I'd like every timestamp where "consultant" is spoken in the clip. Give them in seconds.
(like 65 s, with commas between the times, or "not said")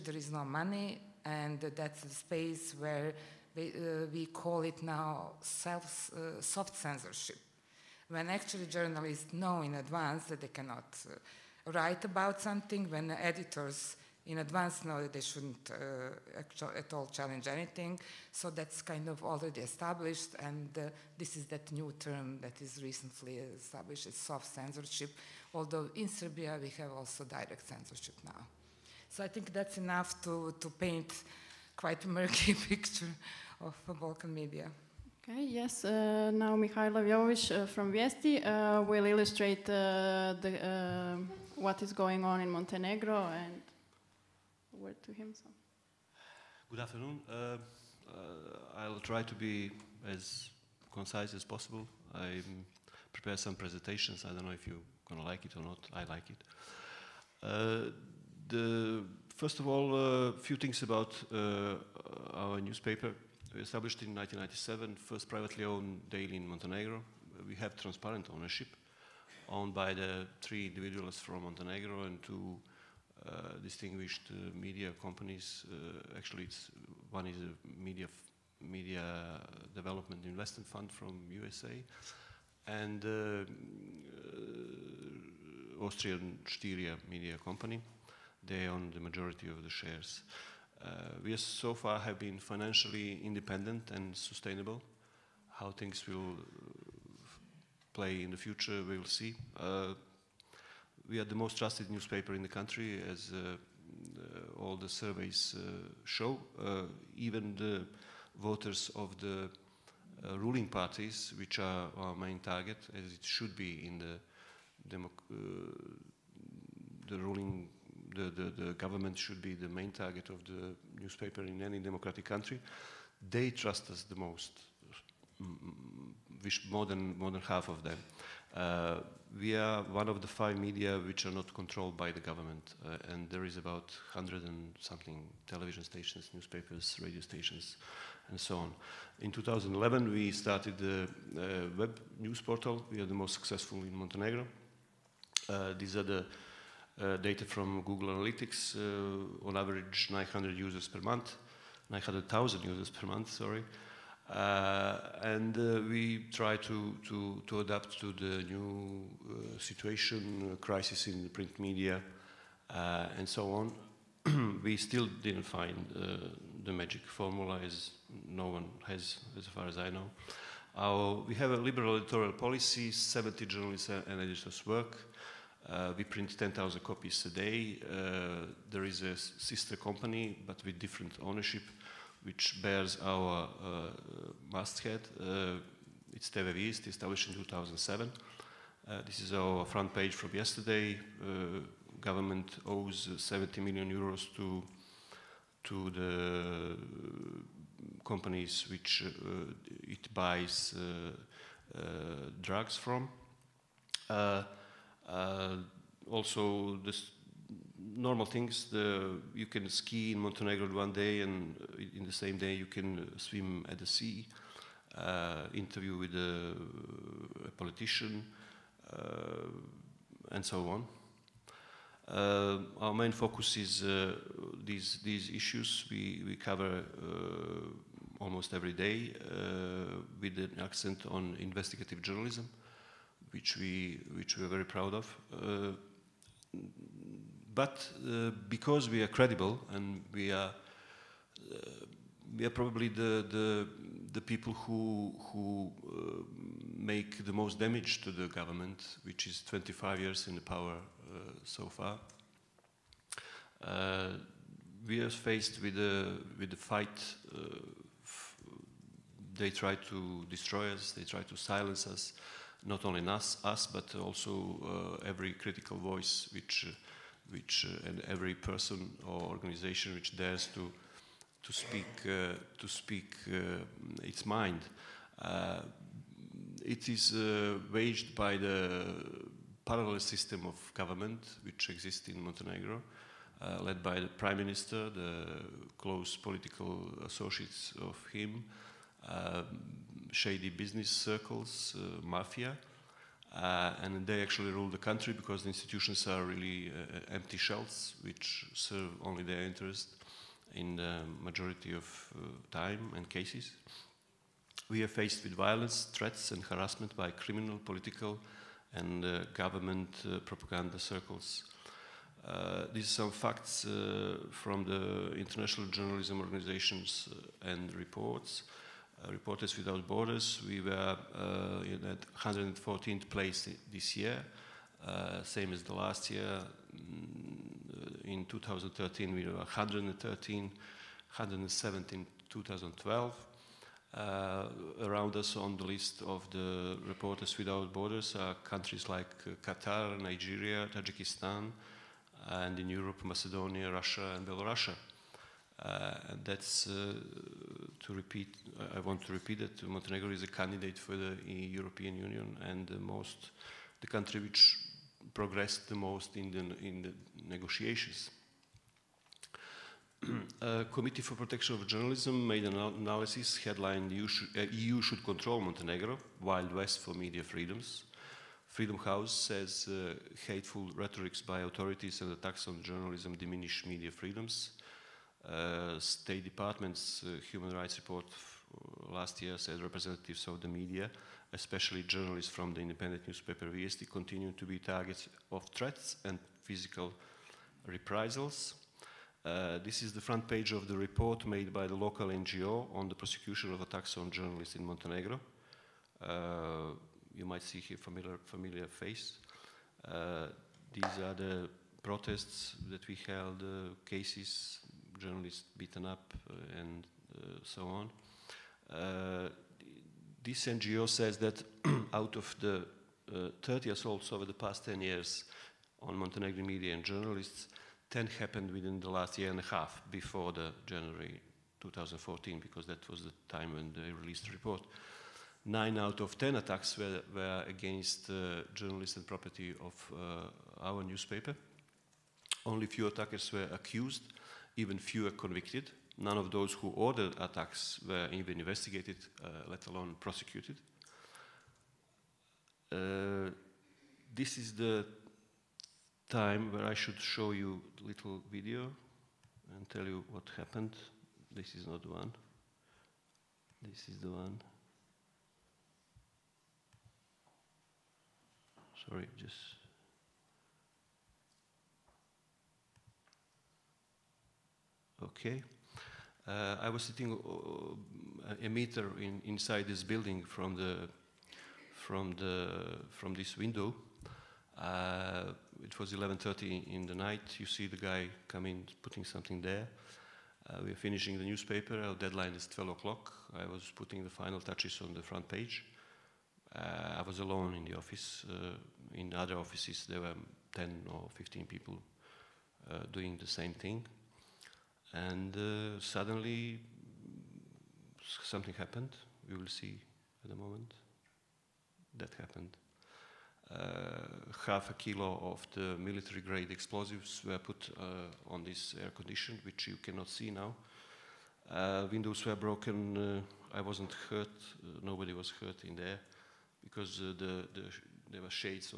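not said.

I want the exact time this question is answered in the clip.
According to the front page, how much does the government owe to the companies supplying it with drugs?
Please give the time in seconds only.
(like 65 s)
193 s.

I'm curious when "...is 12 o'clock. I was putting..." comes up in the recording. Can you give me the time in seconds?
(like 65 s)
482 s.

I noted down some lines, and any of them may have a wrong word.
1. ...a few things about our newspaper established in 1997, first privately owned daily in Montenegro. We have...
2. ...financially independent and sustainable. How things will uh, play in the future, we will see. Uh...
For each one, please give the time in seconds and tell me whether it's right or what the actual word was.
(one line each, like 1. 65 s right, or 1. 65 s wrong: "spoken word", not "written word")
1. 60 s right
2. 92 s right.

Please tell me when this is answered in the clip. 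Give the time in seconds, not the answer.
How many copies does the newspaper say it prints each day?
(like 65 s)
176 s.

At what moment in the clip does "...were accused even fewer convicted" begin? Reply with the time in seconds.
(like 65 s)
433 s.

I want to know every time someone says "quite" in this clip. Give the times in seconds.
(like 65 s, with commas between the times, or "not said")
31 s.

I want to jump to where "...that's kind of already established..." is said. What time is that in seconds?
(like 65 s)
18 s.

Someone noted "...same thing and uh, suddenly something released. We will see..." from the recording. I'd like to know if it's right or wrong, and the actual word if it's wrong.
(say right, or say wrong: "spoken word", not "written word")
wrong: "happened", not "released".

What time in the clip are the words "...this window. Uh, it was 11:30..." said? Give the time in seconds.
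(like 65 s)
473 s.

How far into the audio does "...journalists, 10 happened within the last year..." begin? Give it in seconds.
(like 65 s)
416 s.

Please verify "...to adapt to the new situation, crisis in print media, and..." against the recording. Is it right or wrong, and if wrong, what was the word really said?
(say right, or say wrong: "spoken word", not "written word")
right.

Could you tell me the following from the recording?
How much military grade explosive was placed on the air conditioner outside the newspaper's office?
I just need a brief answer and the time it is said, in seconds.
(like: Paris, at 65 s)
half a kilo, at 504 s.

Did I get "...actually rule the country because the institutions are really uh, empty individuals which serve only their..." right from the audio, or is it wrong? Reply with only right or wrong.
wrong.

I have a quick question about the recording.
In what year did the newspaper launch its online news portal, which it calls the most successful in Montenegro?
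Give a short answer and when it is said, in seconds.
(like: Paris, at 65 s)
2011, at 139 s.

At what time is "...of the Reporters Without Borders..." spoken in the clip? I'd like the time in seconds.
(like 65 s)
336 s.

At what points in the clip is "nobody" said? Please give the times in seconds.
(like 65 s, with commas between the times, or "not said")
514 s.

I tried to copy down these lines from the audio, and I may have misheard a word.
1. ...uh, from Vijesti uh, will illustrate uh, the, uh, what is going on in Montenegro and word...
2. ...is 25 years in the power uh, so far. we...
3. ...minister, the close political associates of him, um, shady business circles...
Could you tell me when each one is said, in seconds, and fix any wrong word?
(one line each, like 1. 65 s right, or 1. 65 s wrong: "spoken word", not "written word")
1. 37 s right
2. 249 s right
3. 284 s right.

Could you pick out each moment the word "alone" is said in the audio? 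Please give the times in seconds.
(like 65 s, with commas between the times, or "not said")
439 s, 487 s.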